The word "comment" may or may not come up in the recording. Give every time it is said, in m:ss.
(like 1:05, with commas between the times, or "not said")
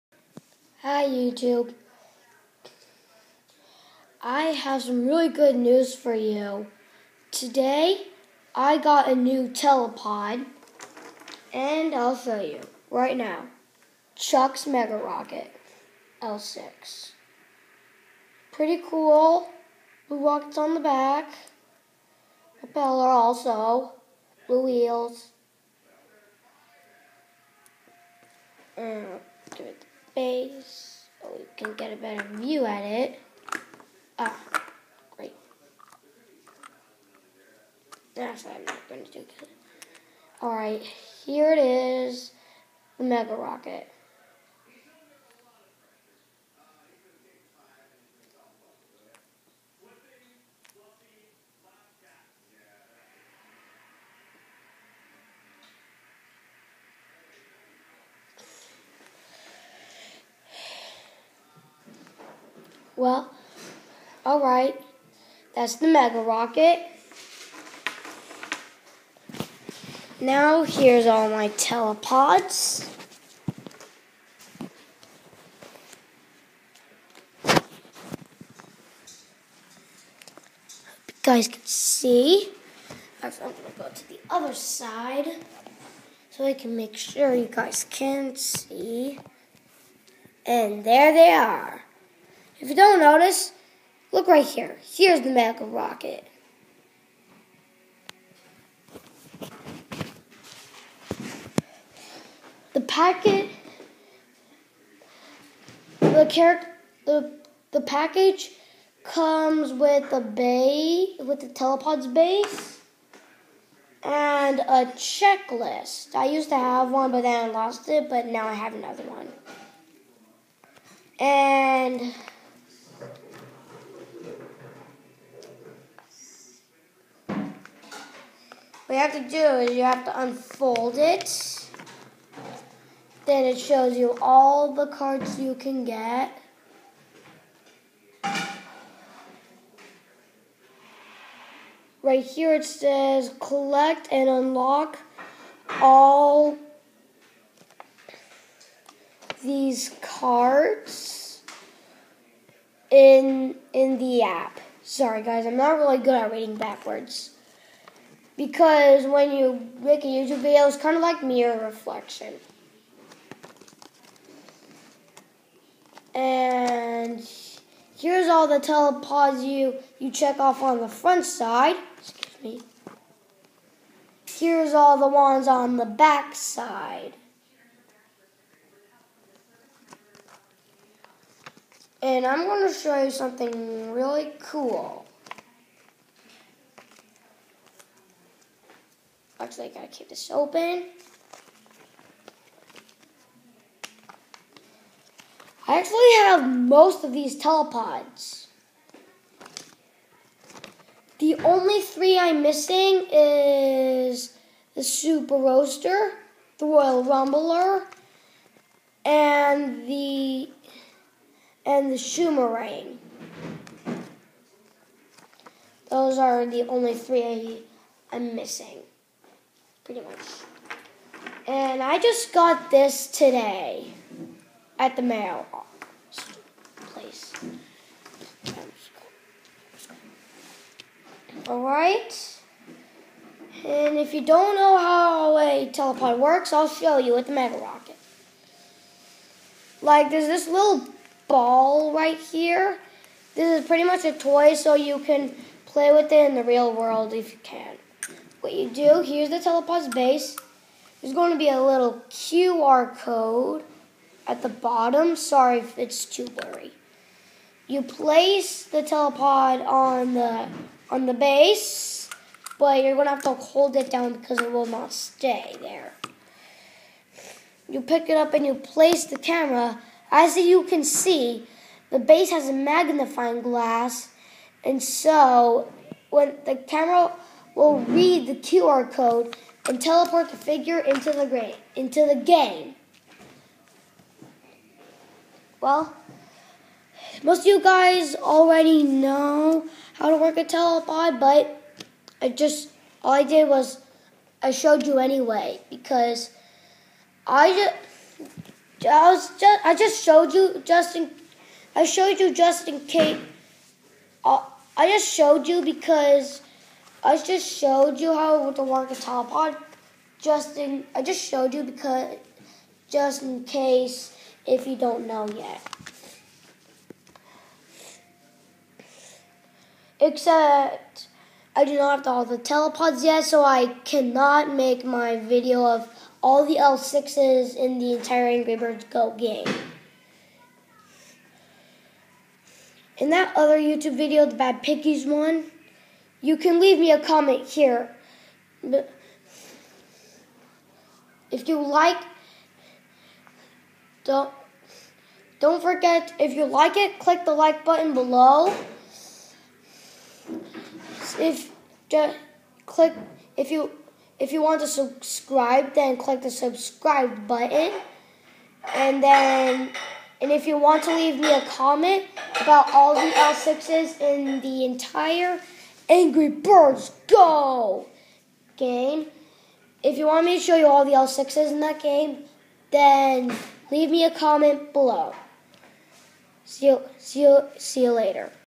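5:36, 6:01, 6:14.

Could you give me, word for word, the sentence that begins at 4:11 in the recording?
There's going to be a little QR code at the bottom.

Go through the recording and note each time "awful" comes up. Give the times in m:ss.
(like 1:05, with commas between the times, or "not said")
not said.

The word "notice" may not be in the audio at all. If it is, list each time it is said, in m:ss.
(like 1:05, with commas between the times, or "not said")
1:32.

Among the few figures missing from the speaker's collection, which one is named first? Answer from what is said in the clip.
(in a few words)
Super Roaster.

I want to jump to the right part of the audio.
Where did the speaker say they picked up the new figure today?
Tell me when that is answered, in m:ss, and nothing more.
3:44.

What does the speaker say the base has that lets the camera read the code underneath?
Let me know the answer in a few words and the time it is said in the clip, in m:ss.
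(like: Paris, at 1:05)
a magnifying glass, at 4:32.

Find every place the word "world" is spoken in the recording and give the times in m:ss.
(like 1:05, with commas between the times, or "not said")
4:06.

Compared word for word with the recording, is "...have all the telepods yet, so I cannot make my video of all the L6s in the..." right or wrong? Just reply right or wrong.
right.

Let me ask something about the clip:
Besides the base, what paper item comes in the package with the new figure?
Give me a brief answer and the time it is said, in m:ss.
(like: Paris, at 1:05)
a checklist, at 1:54.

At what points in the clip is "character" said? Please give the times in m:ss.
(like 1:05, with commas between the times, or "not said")
1:46.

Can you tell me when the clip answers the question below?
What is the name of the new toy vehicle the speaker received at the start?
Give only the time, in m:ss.
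0:14.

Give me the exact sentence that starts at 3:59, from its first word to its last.
Like, there's this little ball right here.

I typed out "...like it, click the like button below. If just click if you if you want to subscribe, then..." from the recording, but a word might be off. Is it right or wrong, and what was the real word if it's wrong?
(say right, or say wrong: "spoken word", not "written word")
right.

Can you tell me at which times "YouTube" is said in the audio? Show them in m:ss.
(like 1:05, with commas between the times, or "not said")
0:01, 2:40, 5:33.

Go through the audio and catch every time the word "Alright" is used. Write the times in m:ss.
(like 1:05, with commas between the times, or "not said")
0:40, 3:51.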